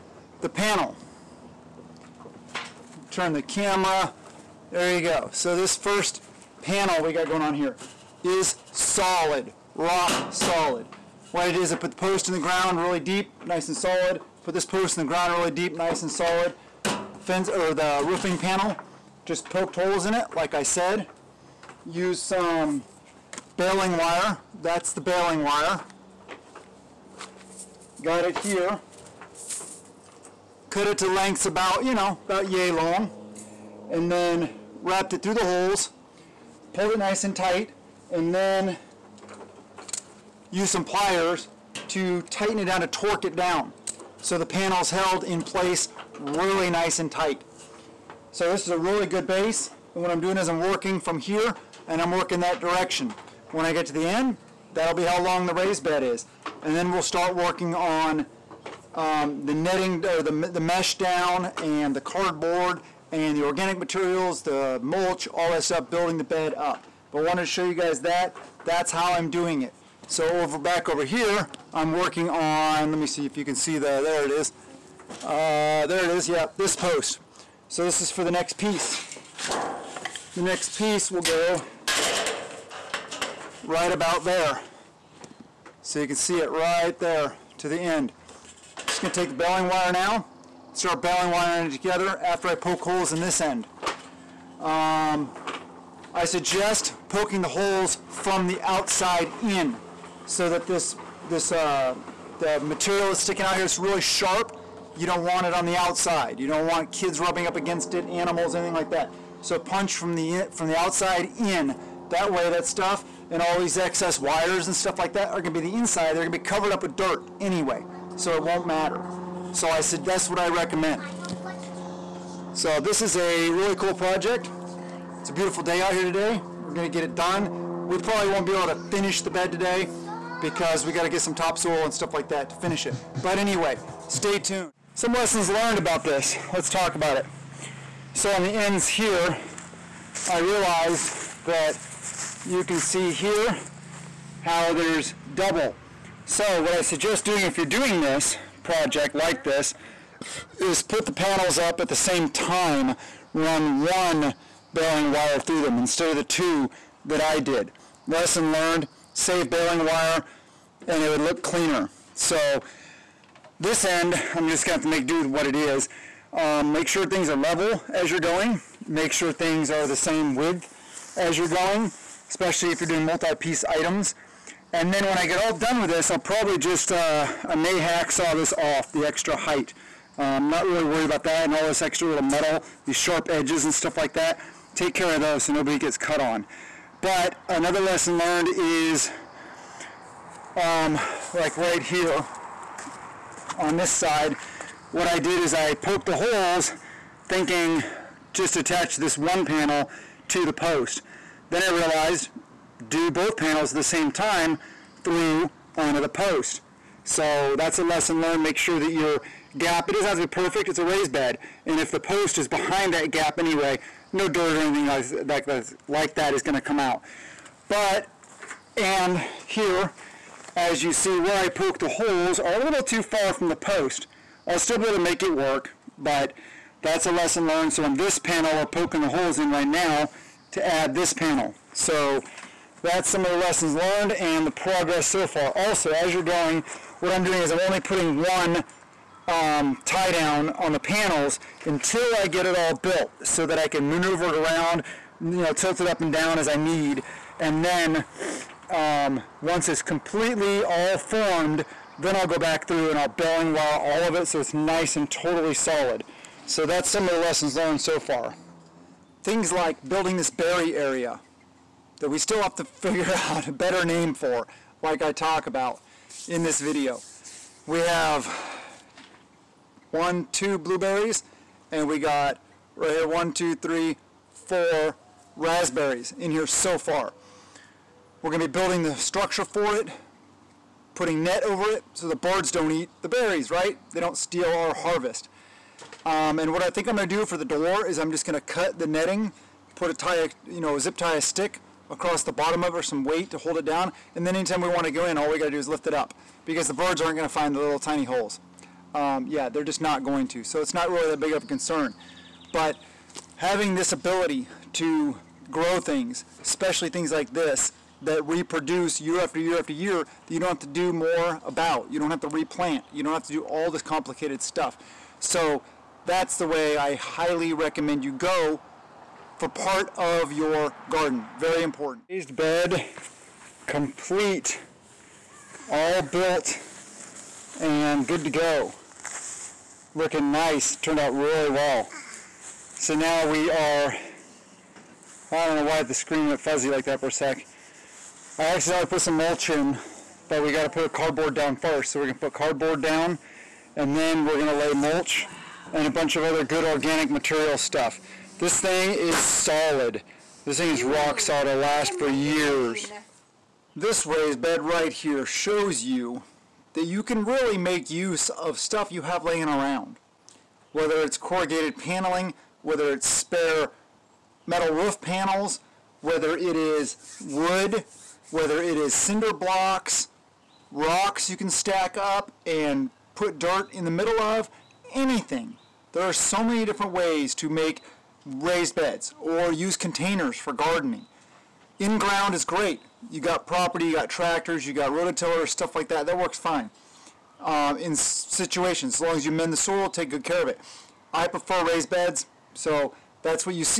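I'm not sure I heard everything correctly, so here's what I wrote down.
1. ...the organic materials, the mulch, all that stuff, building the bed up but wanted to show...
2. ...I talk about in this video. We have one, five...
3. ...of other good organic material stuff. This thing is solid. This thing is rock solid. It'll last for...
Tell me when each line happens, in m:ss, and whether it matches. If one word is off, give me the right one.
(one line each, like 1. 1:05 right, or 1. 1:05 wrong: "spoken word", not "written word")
1. 1:03 right
2. 4:25 wrong: "two", not "five"
3. 5:46 right.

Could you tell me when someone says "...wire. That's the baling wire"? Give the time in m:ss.
0:23.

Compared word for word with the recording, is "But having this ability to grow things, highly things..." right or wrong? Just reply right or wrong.
wrong.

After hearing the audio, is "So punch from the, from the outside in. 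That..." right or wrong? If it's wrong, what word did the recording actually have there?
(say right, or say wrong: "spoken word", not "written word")
right.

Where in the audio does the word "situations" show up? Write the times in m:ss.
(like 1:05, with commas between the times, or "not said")
6:27.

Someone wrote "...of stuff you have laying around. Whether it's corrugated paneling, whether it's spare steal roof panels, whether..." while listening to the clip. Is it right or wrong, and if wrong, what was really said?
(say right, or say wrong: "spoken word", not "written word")
wrong: "metal", not "steal".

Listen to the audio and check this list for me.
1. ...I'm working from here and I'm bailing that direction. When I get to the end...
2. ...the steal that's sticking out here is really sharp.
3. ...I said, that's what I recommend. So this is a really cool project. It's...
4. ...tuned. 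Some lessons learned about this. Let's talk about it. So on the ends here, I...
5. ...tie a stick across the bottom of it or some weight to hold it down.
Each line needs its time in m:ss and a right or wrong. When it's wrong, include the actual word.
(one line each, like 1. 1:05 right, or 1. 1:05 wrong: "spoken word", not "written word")
1. 0:50 wrong: "working", not "bailing"
2. 1:42 wrong: "material", not "steal"
3. 1:59 right
4. 2:14 right
5. 4:50 right.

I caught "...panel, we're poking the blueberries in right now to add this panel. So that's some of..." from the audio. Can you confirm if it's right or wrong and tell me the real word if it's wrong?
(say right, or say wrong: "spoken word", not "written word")
wrong: "holes", not "blueberries".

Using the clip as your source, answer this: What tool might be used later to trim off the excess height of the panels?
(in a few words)
Hacksaw.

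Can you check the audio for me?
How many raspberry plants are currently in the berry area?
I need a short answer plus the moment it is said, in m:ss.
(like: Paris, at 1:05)
4, at 4:34.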